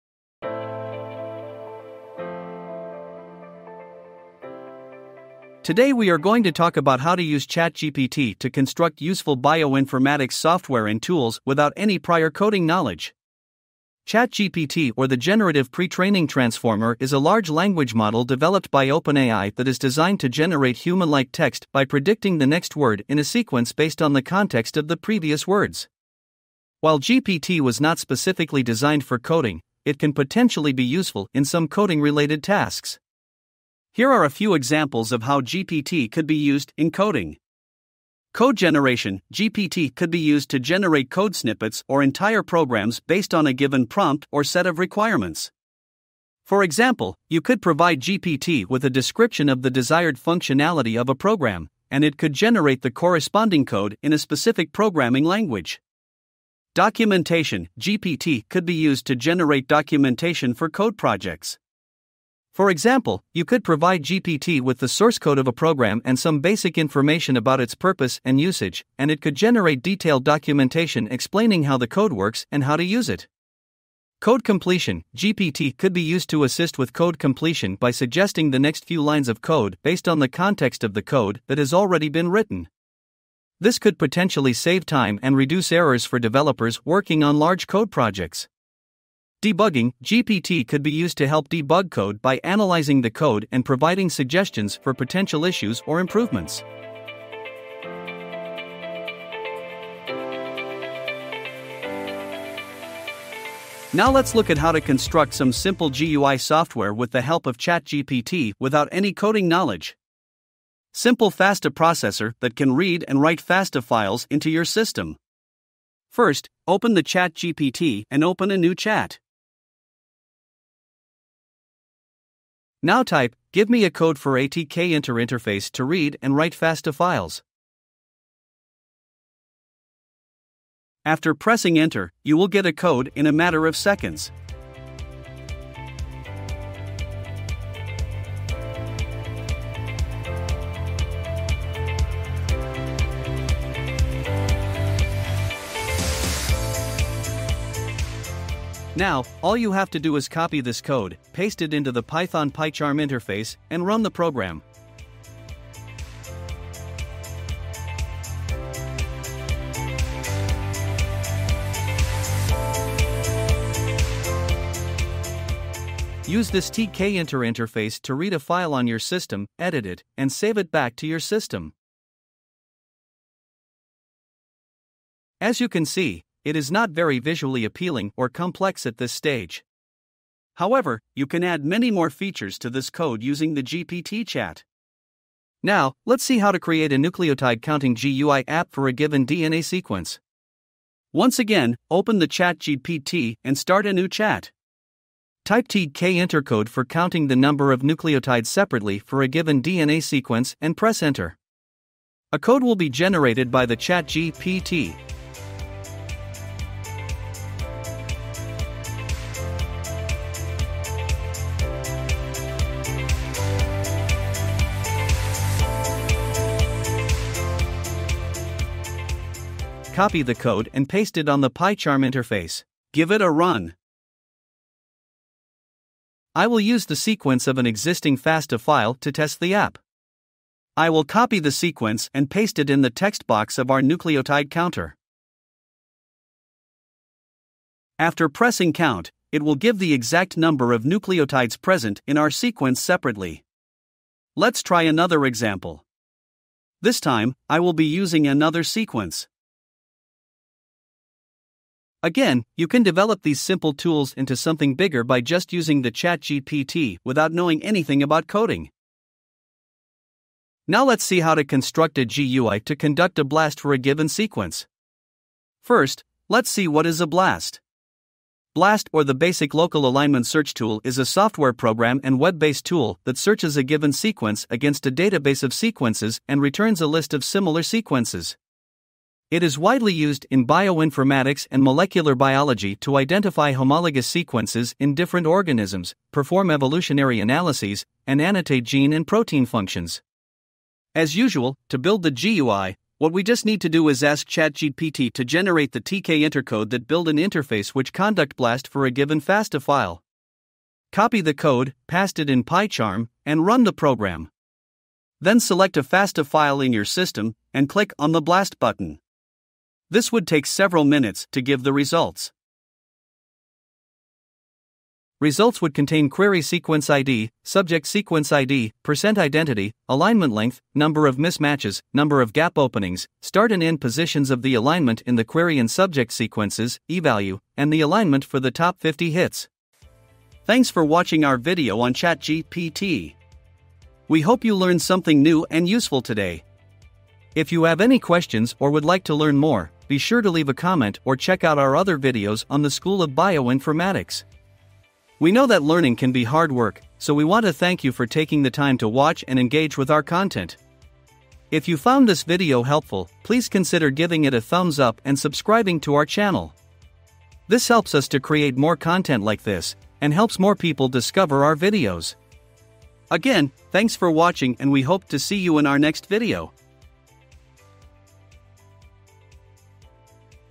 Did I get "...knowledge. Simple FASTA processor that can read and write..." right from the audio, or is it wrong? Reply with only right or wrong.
right.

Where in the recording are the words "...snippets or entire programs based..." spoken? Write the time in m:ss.
0:41.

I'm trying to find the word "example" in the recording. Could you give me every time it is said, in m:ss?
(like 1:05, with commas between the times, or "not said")
0:34, 0:46, 1:02, 4:05.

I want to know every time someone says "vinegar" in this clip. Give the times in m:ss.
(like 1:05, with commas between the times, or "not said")
not said.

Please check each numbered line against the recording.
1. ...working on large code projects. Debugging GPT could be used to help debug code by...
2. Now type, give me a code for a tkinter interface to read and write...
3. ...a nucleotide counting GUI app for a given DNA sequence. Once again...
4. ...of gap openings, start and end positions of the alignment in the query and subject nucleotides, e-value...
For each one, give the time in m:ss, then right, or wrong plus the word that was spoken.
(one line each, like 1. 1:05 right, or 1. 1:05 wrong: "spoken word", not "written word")
1. 1:26 right
2. 2:02 right
3. 3:06 right
4. 5:22 wrong: "sequences", not "nucleotides".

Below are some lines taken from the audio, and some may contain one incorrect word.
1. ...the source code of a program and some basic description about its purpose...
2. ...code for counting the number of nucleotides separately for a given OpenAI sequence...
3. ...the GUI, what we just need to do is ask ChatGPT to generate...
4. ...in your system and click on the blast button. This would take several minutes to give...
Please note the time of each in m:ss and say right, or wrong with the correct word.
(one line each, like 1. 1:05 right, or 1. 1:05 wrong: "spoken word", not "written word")
1. 1:04 wrong: "information", not "description"
2. 3:16 wrong: "DNA", not "OpenAI"
3. 4:52 right
4. 5:06 right.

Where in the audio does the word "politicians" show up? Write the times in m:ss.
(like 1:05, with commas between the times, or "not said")
not said.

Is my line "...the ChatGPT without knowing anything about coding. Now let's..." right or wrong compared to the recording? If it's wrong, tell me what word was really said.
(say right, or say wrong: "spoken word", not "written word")
right.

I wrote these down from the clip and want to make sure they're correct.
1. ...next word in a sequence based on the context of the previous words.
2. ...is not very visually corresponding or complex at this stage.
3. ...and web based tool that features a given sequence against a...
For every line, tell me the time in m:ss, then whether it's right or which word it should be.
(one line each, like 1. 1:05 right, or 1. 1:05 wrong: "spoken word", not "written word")
1. 0:22 right
2. 2:56 wrong: "appealing", not "corresponding"
3. 4:32 wrong: "searches", not "features".